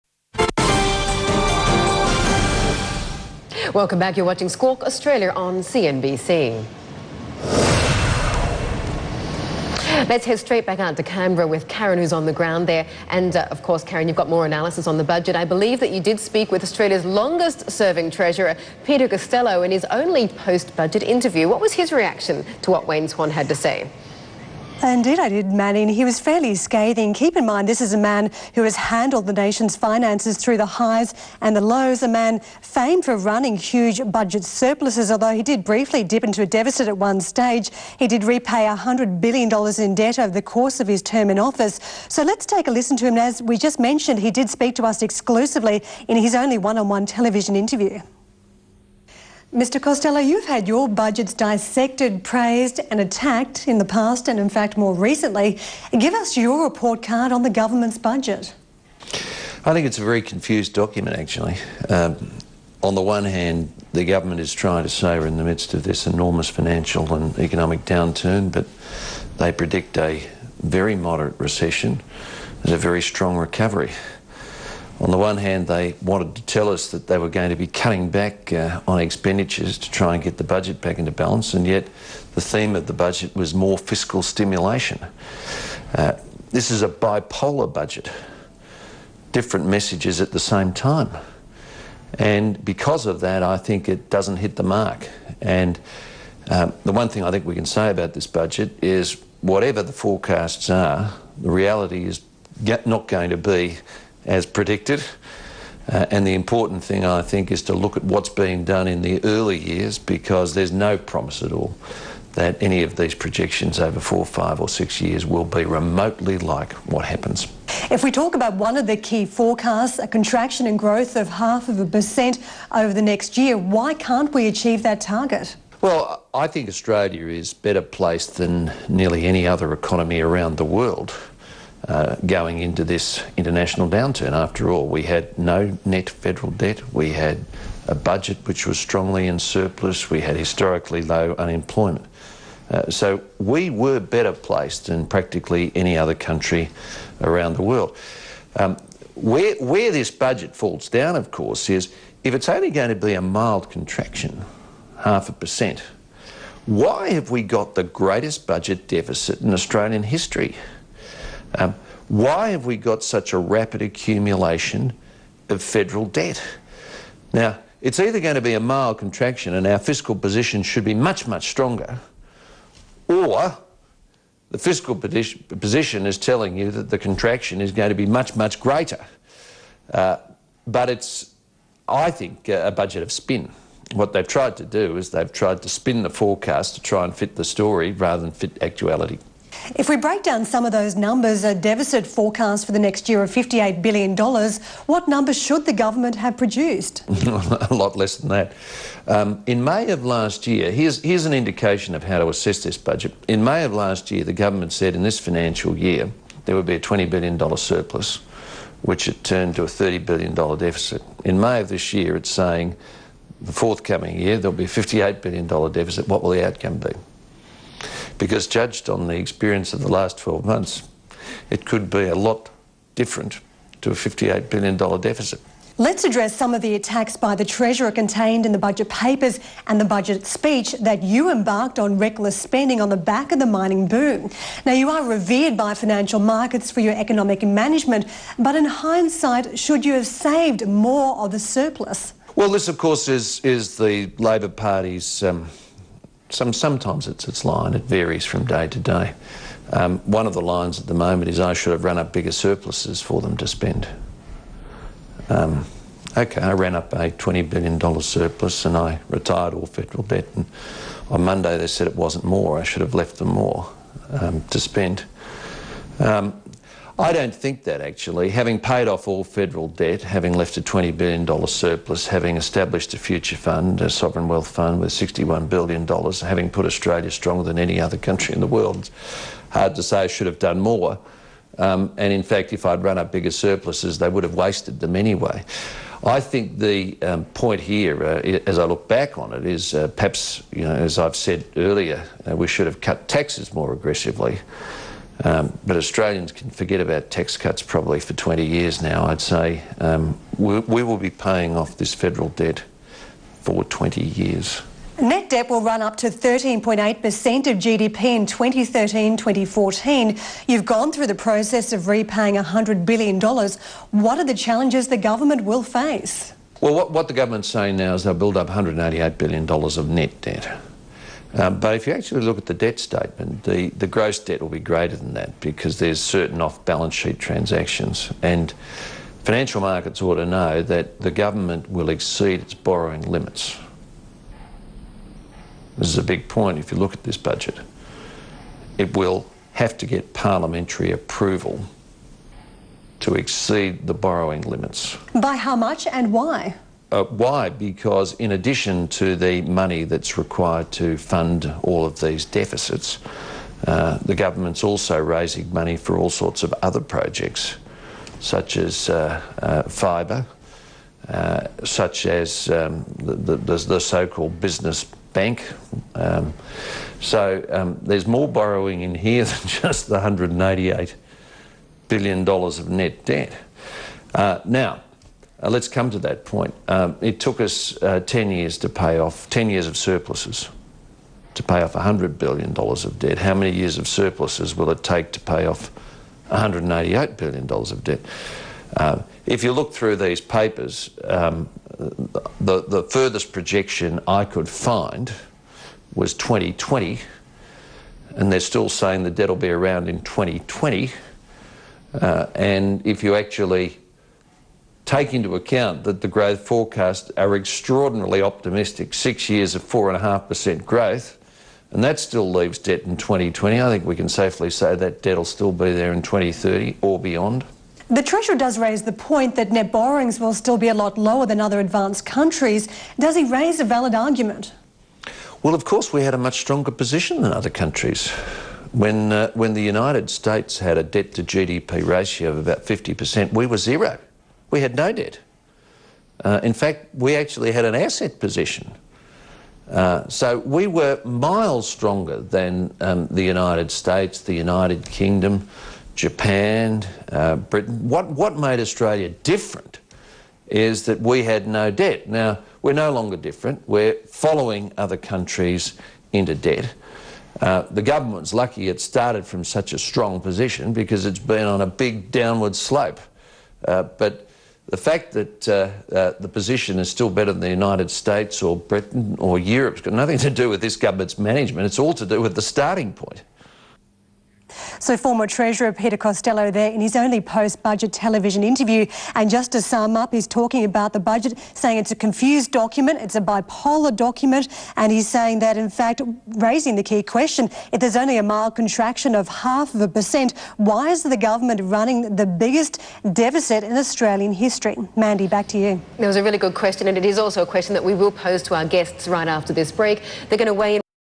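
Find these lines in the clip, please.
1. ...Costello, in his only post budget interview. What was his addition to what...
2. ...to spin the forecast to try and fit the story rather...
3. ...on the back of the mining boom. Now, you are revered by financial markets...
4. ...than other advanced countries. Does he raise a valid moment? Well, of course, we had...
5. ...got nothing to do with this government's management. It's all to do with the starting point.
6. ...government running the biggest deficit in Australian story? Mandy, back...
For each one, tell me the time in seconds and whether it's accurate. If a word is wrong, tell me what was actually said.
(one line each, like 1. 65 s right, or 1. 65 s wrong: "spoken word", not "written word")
1. 19 s wrong: "reaction", not "addition"
2. 185 s right
3. 232 s right
4. 421 s wrong: "argument", not "moment"
5. 469 s right
6. 491 s wrong: "history", not "story".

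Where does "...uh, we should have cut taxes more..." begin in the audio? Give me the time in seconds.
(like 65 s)
292 s.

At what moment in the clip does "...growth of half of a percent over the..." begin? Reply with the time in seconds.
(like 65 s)
120 s.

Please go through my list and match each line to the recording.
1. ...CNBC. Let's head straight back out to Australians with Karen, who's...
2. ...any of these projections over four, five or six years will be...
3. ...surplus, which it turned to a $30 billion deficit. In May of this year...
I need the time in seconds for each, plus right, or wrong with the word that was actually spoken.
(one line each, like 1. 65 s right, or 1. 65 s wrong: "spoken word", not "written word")
1. 5 s wrong: "Canberra", not "Australians"
2. 112 s right
3. 207 s right.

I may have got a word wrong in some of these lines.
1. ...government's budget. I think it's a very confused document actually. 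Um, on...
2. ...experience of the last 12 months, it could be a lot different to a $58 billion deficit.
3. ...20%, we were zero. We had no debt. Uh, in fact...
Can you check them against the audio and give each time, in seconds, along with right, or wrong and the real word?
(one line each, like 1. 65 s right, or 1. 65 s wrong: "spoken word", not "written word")
1. 57 s right
2. 219 s right
3. 432 s wrong: "50", not "20".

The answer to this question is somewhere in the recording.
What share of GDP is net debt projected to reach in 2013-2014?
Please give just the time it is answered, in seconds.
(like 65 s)
306 s.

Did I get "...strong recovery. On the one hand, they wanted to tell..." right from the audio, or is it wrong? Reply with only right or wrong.
right.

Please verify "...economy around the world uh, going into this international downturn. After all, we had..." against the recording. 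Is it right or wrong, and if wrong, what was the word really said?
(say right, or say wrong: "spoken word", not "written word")
right.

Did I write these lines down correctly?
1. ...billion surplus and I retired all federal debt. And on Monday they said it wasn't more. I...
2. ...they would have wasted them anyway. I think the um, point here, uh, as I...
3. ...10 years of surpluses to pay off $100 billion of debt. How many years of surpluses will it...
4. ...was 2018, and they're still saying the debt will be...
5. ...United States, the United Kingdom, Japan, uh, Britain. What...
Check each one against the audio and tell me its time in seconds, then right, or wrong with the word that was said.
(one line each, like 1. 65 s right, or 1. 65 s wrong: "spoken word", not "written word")
1. 257 s right
2. 283 s right
3. 379 s right
4. 395 s wrong: "2020", not "2018"
5. 443 s right.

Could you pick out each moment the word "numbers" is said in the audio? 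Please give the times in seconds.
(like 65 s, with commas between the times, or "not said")
190 s, 195 s.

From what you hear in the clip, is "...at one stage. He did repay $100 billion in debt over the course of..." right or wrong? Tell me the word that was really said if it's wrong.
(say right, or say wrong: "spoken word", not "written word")
right.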